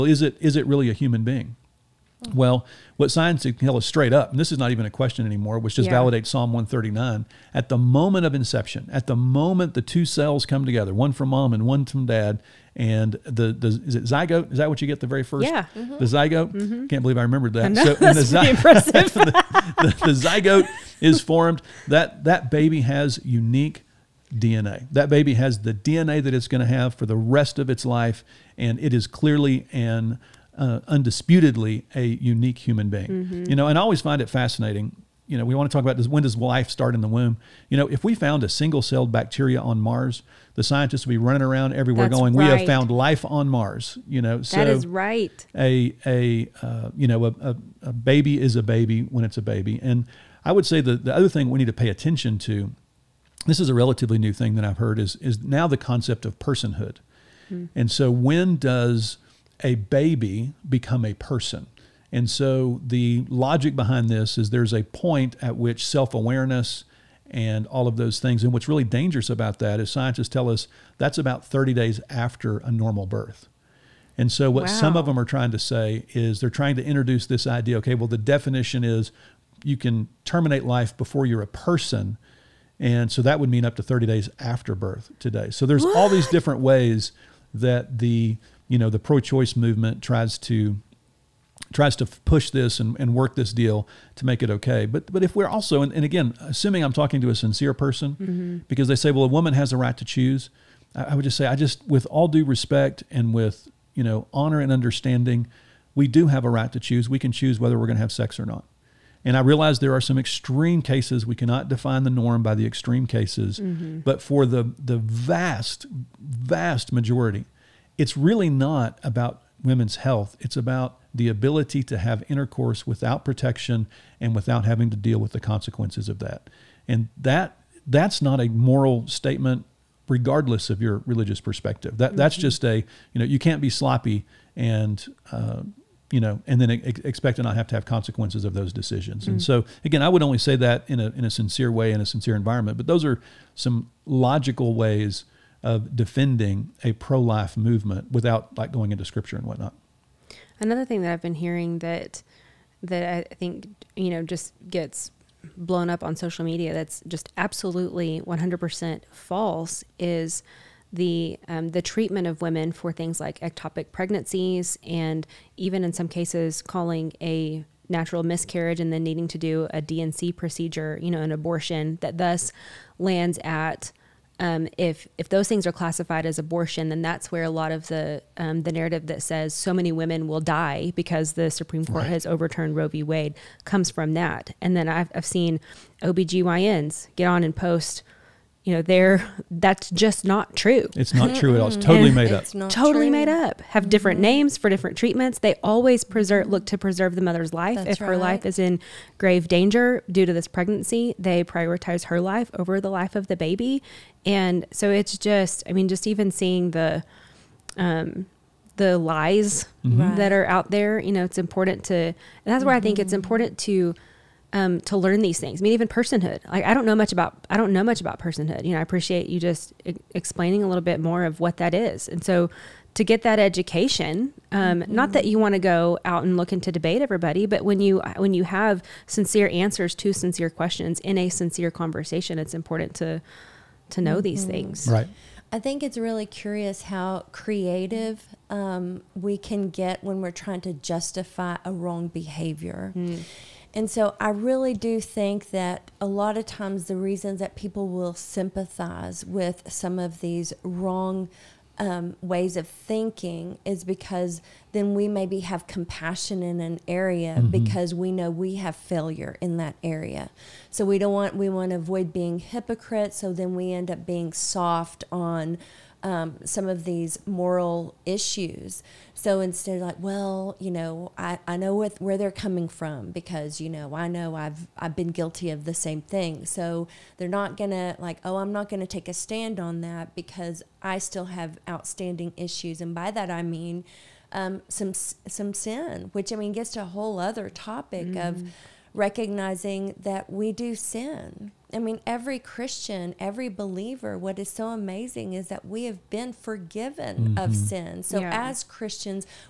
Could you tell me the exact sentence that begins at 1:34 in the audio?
But but if we're also and, and again, assuming I'm talking to a sincere person, mm -hmm.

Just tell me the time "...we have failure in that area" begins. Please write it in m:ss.
4:18.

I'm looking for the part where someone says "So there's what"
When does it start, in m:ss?
1:25.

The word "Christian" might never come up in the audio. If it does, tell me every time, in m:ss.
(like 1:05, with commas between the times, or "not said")
4:52, 4:58.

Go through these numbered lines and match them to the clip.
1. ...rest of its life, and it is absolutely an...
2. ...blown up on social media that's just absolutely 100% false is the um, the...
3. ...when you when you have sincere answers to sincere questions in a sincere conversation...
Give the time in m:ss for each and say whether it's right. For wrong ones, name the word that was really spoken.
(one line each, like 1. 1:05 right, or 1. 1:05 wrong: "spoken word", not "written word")
1. 0:27 wrong: "clearly", not "absolutely"
2. 2:35 right
3. 3:47 right.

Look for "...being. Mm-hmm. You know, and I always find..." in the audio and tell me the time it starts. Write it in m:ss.
0:32.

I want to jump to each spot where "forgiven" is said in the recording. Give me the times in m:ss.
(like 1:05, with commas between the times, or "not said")
4:56.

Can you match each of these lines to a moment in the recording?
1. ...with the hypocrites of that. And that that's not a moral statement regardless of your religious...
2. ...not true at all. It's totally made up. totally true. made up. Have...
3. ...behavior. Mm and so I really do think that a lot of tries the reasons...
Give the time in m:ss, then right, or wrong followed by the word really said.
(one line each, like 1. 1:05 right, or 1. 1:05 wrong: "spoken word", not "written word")
1. 2:05 wrong: "consequences", not "hypocrites"
2. 3:11 right
3. 4:02 wrong: "times", not "tries".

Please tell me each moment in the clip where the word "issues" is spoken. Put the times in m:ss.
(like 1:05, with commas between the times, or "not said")
4:28, 4:42.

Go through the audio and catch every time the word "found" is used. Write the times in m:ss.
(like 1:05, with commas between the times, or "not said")
0:38, 0:42.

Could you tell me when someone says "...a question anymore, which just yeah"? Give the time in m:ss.
0:04.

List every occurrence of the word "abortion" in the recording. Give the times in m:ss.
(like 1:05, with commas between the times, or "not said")
2:51, 2:56.